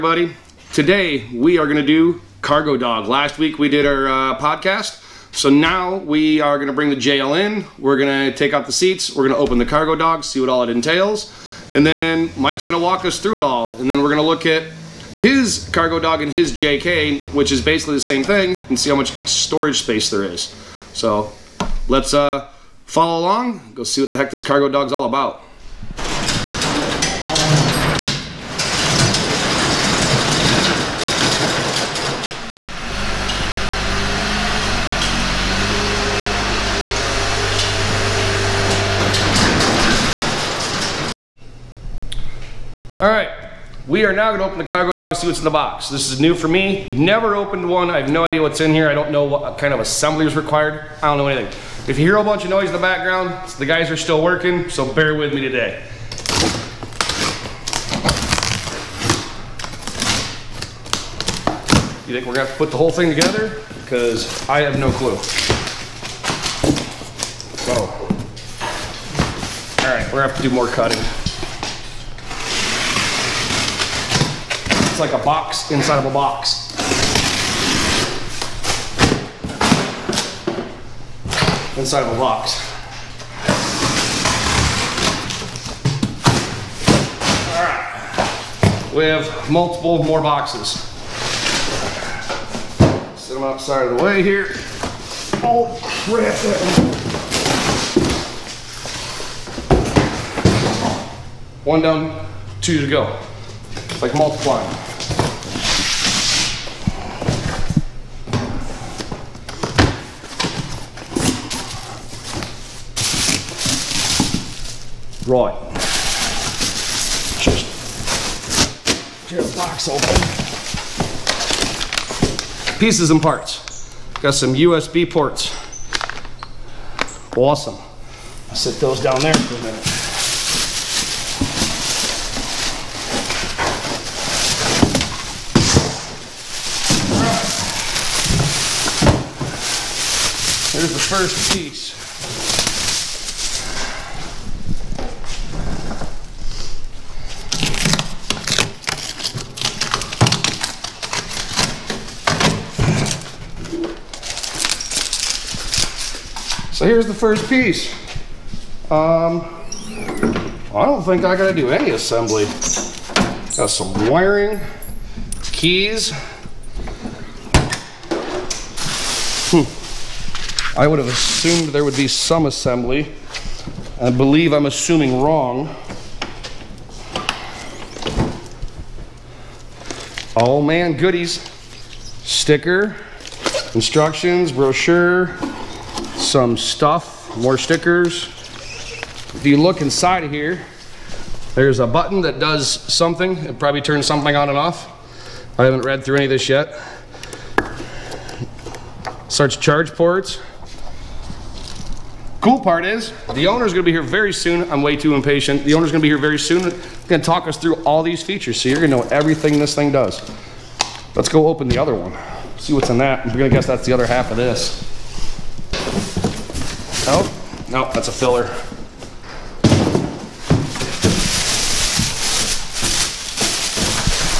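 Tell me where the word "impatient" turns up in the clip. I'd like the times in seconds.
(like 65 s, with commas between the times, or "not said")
205 s.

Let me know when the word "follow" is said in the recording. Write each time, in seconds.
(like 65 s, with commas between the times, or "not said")
22 s.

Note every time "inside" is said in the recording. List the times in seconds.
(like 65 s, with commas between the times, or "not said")
75 s, 81 s, 189 s.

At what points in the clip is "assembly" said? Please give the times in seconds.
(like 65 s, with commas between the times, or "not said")
49 s, 161 s, 172 s.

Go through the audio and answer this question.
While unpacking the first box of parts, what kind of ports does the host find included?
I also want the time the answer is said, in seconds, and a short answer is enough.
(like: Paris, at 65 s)
USB ports, at 124 s.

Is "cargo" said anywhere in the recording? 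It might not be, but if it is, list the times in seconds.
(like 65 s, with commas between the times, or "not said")
2 s, 9 s, 15 s, 24 s, 44 s.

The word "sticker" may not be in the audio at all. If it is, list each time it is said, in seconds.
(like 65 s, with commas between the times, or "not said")
182 s, 187 s.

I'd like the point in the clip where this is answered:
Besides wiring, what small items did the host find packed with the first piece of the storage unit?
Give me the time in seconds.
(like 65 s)
165 s.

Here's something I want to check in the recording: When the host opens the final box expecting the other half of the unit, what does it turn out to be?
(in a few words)
A filler.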